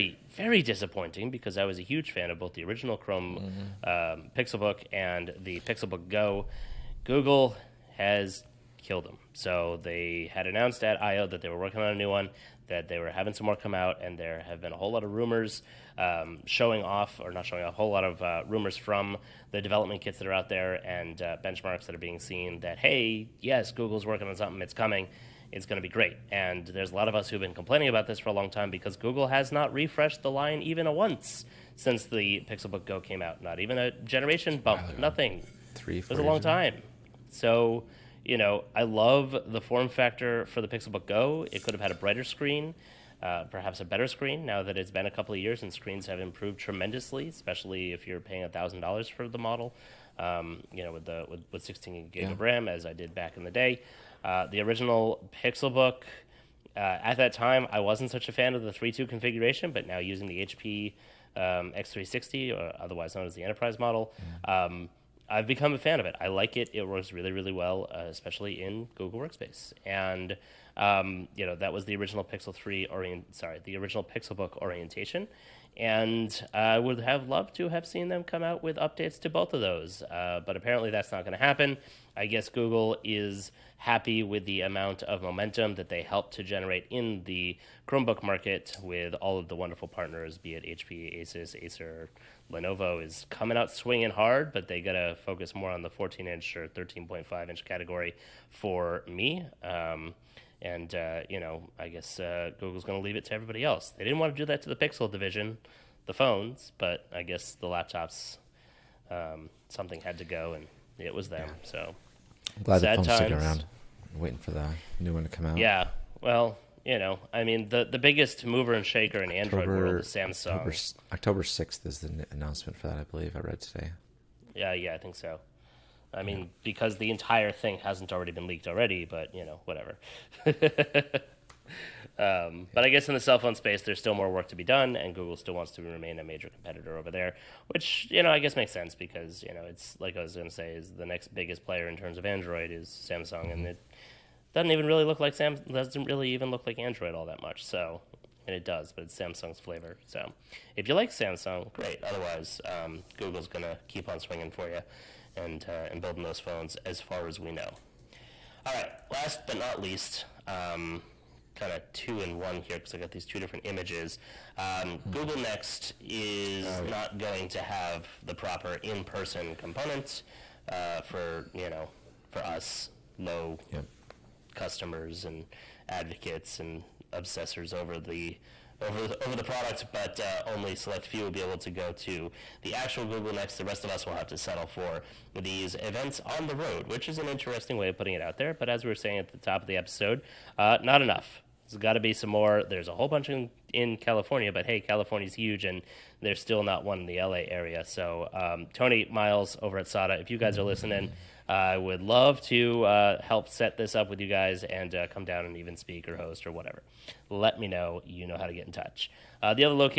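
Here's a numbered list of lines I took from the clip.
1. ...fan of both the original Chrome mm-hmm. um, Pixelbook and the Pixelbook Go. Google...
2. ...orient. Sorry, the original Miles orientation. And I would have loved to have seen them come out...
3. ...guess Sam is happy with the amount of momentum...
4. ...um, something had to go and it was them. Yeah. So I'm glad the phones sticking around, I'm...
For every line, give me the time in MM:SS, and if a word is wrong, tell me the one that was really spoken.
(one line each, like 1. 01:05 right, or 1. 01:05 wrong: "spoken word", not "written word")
1. 00:02 right
2. 01:12 wrong: "Pixelbook", not "Miles"
3. 01:22 wrong: "Google", not "Sam"
4. 01:49 right.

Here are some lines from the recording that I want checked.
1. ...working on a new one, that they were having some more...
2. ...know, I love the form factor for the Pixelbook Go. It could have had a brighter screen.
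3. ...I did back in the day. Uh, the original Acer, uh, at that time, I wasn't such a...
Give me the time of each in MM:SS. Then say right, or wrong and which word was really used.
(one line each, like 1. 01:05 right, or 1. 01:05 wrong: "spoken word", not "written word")
1. 00:11 right
2. 00:38 right
3. 00:52 wrong: "Pixelbook", not "Acer".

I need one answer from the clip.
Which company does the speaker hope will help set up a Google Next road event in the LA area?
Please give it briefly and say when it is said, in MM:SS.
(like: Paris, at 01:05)
SADA, at 03:19.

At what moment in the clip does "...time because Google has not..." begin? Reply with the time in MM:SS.
00:28.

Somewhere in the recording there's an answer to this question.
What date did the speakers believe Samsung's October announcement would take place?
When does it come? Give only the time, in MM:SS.
02:01.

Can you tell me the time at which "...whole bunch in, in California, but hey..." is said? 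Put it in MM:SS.
03:12.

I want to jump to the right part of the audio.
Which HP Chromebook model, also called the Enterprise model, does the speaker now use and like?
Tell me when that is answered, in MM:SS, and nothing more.
01:01.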